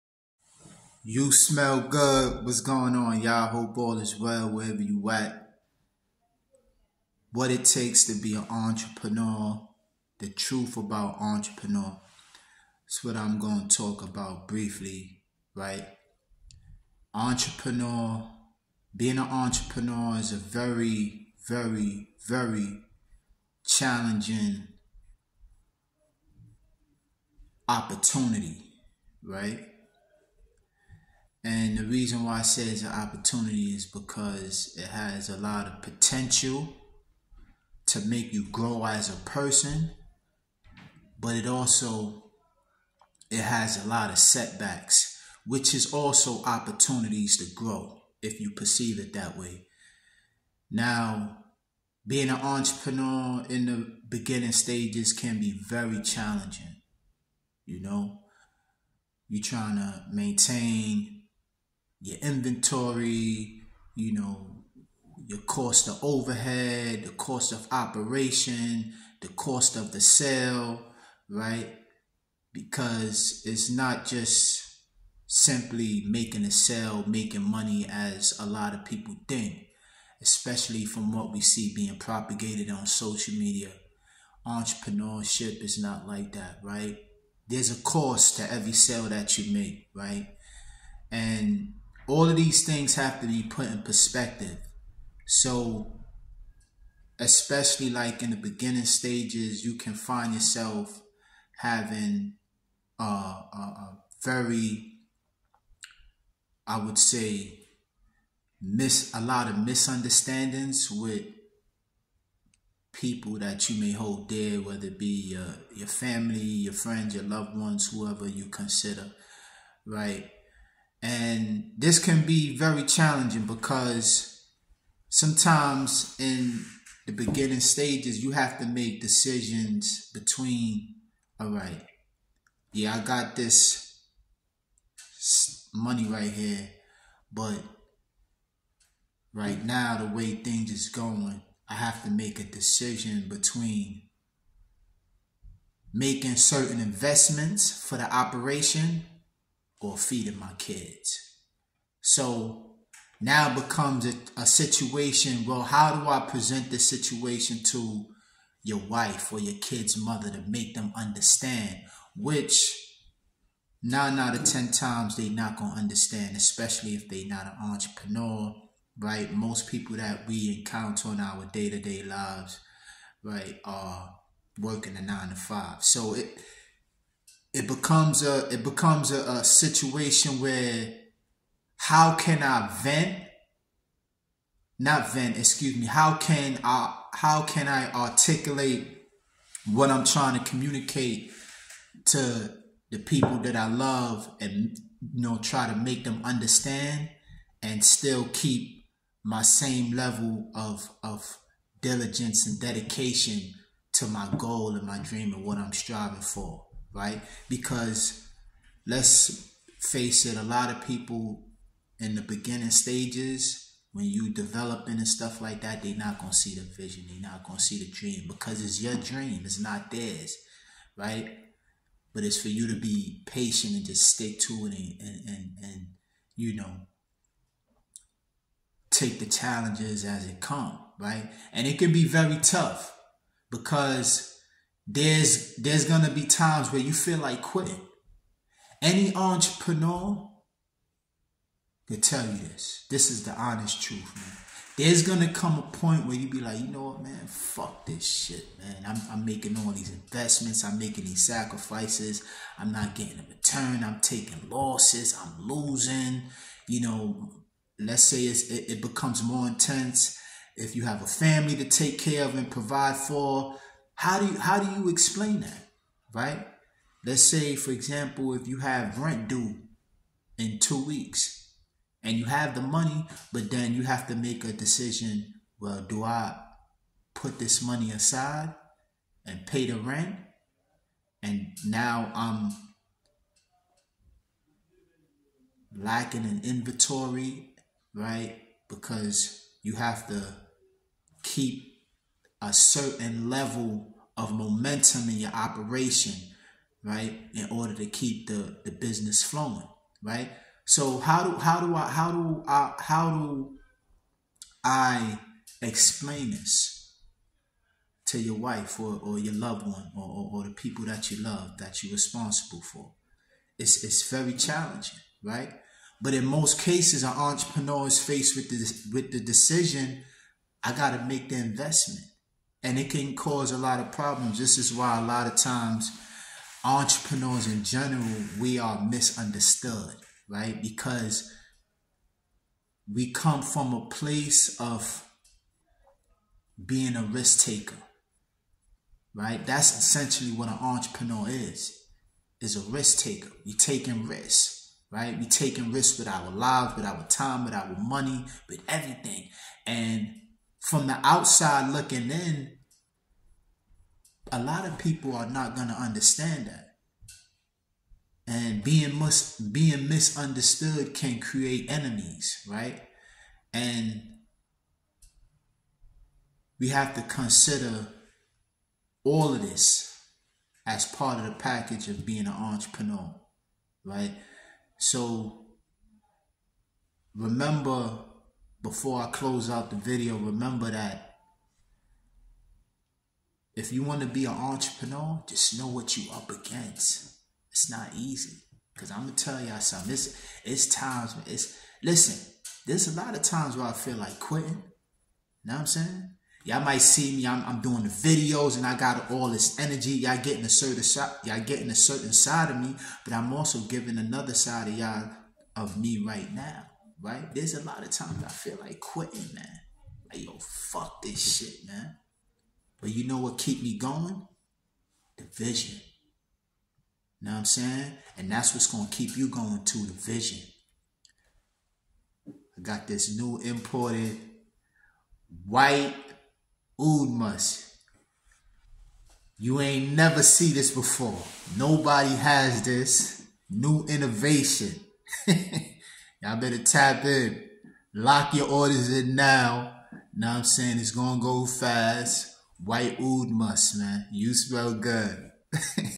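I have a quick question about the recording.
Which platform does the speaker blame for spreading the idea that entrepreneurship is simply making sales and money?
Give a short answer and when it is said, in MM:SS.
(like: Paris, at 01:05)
Social media, at 01:22.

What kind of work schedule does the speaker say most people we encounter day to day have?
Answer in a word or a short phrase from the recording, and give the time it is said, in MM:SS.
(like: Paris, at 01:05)
Nine to five, at 02:55.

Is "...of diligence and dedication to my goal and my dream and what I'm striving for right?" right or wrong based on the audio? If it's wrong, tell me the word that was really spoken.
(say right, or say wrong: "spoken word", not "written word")
right.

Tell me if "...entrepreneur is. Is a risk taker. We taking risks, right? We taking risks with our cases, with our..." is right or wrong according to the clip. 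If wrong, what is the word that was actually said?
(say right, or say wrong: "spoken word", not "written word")
wrong: "lives", not "cases".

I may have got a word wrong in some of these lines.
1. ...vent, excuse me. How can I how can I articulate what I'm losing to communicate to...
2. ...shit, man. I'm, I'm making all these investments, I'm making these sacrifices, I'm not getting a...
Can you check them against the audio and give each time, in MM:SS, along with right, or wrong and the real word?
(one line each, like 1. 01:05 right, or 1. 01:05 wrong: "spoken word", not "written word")
1. 03:05 wrong: "trying", not "losing"
2. 04:08 right.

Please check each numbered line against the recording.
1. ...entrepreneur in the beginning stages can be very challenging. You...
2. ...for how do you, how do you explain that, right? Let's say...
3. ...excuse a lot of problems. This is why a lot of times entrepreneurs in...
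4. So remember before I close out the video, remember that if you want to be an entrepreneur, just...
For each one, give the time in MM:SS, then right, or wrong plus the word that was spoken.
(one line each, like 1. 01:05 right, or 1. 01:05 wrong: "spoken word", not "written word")
1. 00:52 right
2. 04:22 right
3. 05:23 wrong: "cause", not "excuse"
4. 06:14 right.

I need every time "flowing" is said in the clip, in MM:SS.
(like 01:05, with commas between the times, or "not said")
04:59.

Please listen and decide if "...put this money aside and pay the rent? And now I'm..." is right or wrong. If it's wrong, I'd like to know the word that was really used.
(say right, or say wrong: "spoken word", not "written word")
right.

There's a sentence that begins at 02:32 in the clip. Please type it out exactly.
So now becomes a, a situation.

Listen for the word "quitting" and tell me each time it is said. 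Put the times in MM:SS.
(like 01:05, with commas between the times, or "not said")
03:57, 06:34, 06:48.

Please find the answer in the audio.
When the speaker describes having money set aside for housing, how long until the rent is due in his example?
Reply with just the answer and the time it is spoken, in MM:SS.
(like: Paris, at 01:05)
2 weeks, at 04:30.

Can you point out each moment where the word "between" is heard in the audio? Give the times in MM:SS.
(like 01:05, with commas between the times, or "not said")
02:10, 02:23.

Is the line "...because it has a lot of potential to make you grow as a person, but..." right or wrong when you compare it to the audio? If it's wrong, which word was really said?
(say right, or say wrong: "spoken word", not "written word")
right.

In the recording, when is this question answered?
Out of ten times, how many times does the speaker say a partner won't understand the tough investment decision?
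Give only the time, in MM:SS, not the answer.
02:43.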